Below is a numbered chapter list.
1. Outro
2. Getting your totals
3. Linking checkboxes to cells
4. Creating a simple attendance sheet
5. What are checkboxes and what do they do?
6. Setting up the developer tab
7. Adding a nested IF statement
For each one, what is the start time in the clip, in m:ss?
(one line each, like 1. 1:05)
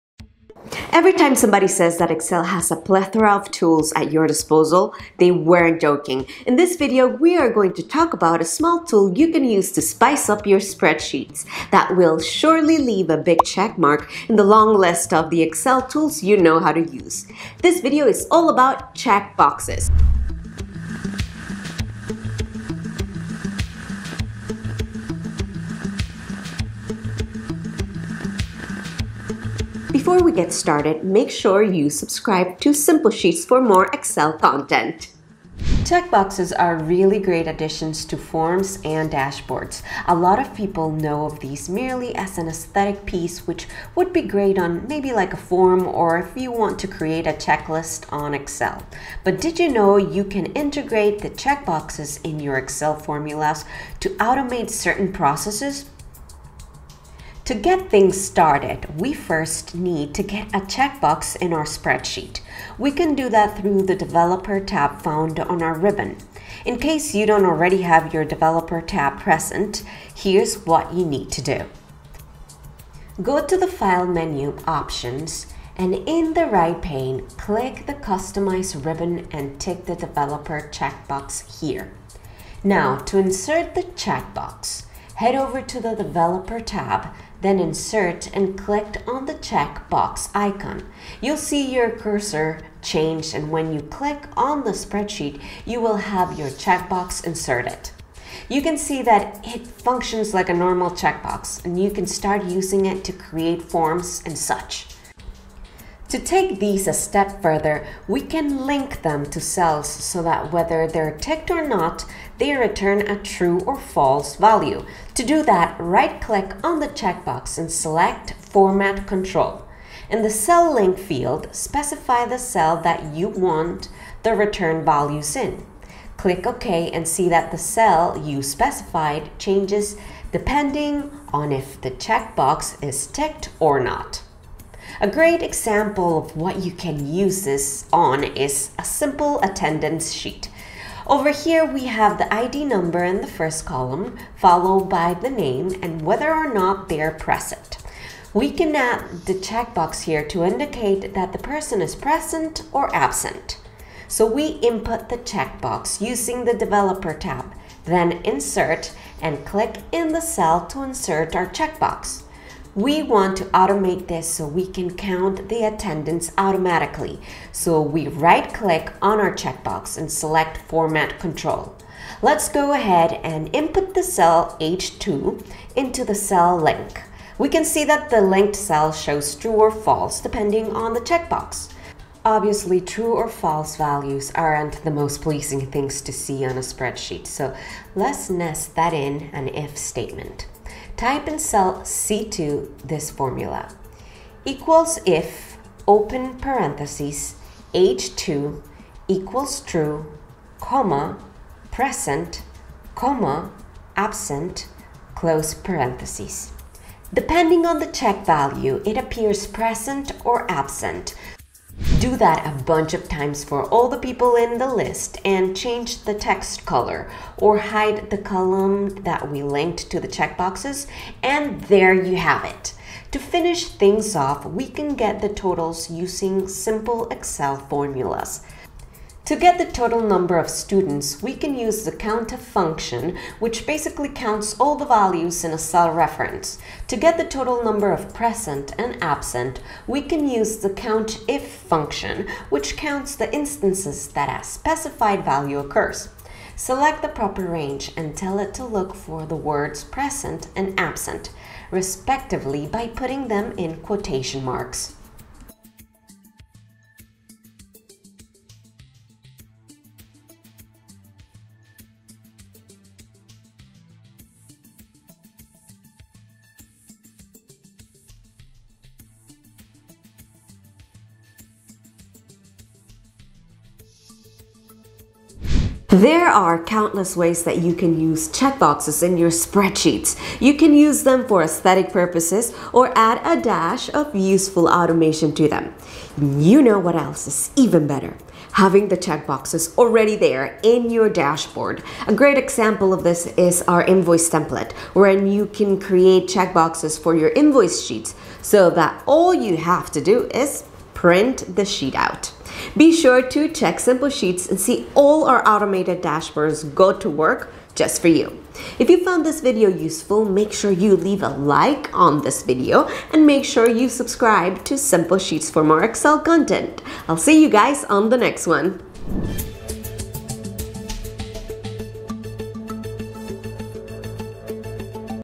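1. 4:35
2. 3:48
3. 1:45
4. 2:20
5. 0:30
6. 1:00
7. 3:02.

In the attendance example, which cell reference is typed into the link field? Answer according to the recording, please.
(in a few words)
H2.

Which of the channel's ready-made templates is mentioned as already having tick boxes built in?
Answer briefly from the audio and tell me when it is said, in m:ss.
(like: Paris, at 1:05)
invoice template, at 4:53.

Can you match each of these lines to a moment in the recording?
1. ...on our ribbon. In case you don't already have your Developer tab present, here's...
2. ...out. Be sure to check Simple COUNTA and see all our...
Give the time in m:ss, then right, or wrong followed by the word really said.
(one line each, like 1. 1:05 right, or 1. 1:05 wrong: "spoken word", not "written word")
1. 1:05 right
2. 5:01 wrong: "Sheets", not "COUNTA".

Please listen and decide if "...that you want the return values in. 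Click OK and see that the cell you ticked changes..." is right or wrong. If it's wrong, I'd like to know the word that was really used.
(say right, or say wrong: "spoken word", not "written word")
wrong: "specified", not "ticked".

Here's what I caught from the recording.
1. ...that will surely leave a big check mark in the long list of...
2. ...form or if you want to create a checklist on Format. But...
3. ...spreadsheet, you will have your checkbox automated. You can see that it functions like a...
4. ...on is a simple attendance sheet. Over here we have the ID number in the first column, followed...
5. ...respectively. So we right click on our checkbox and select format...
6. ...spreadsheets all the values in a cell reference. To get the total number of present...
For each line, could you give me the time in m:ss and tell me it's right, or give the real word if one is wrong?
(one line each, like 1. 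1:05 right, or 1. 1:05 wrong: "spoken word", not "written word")
1. 0:11 right
2. 0:45 wrong: "Excel", not "Format"
3. 1:34 wrong: "inserted", not "automated"
4. 2:17 right
5. 2:46 wrong: "automatically", not "respectively"
6. 3:54 wrong: "counts", not "spreadsheets".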